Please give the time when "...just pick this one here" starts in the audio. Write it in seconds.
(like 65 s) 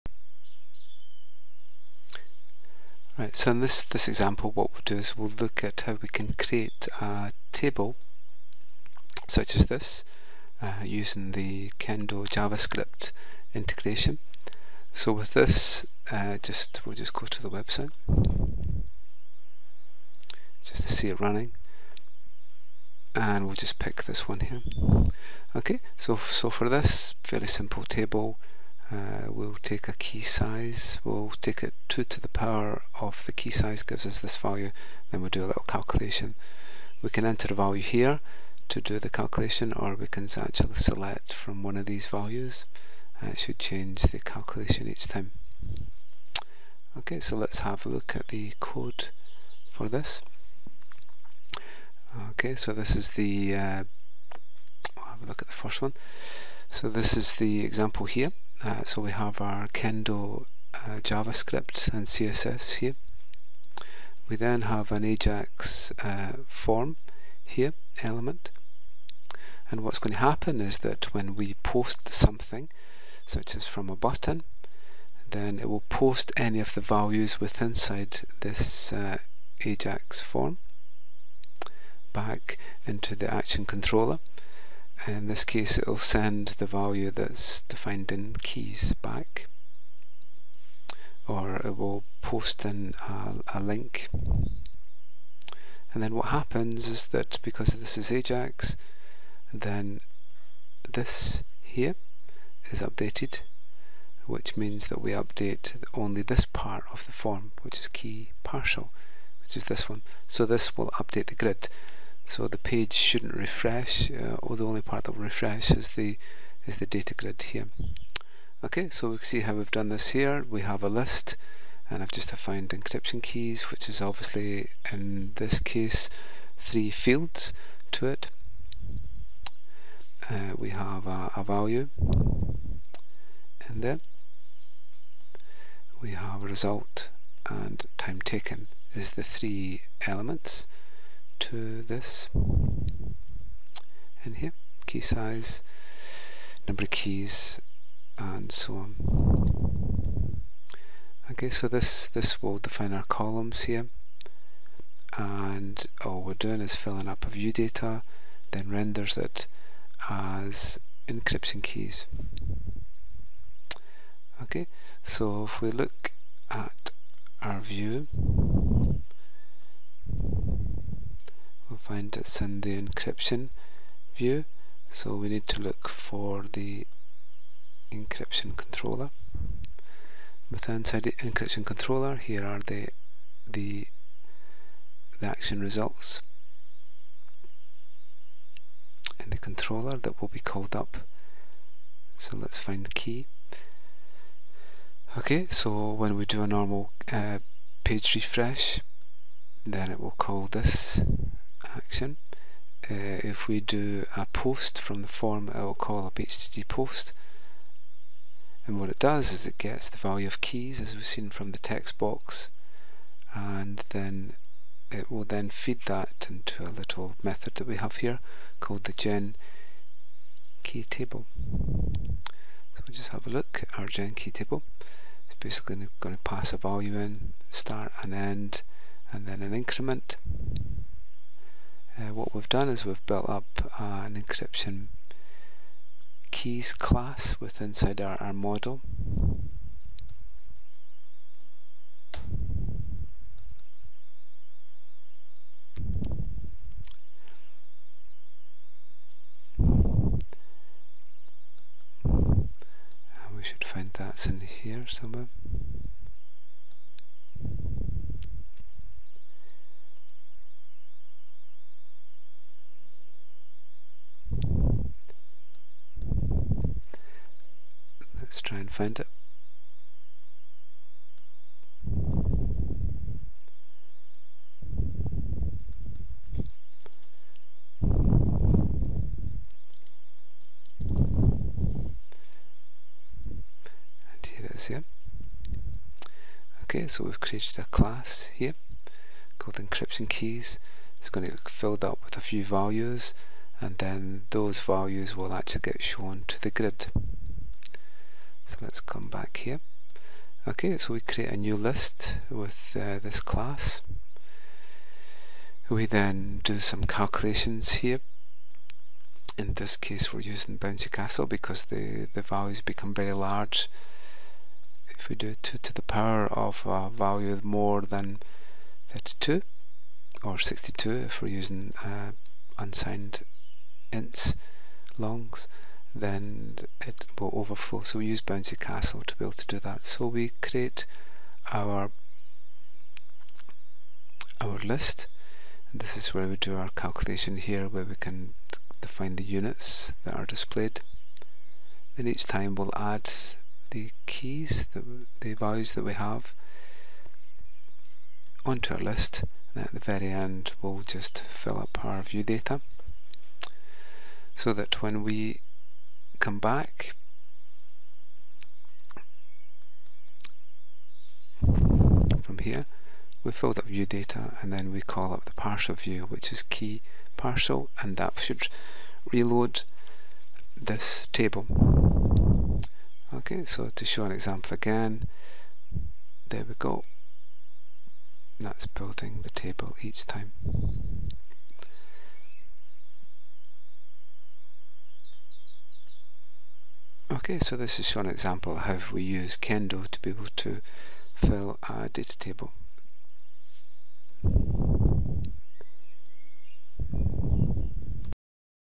23 s.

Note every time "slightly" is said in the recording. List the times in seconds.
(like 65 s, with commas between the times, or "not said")
not said.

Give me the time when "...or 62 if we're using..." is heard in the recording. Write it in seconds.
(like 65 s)
320 s.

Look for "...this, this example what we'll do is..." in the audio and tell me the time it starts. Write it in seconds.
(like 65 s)
3 s.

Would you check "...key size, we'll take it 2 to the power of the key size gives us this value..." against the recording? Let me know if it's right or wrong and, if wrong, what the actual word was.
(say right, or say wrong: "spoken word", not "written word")
right.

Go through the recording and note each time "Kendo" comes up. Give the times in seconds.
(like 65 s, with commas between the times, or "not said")
11 s, 59 s, 389 s.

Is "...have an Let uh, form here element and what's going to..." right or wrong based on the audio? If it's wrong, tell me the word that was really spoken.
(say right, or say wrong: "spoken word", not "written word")
wrong: "Ajax", not "Let".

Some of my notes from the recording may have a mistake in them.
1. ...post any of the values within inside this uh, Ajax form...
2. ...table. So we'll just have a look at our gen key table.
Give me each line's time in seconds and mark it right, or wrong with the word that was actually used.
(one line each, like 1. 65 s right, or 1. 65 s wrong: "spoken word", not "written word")
1. 75 s right
2. 220 s right.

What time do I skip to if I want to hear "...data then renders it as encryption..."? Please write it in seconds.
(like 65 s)
157 s.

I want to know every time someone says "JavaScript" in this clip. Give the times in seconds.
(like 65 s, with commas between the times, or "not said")
12 s, 61 s.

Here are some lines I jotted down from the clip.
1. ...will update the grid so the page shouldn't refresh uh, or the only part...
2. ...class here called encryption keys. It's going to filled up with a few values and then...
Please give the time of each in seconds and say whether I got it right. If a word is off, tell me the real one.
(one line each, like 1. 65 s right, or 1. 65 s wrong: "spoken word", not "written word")
1. 110 s right
2. 287 s right.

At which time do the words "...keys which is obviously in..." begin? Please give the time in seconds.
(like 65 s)
123 s.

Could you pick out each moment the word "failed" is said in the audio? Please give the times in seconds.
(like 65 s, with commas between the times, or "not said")
not said.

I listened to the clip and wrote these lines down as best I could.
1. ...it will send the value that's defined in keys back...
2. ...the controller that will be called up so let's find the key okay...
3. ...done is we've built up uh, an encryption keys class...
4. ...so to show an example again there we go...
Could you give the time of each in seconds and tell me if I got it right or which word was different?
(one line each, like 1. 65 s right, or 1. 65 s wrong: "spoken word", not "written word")
1. 85 s right
2. 189 s right
3. 232 s right
4. 373 s right.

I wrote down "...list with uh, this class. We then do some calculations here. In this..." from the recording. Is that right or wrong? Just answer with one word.
right.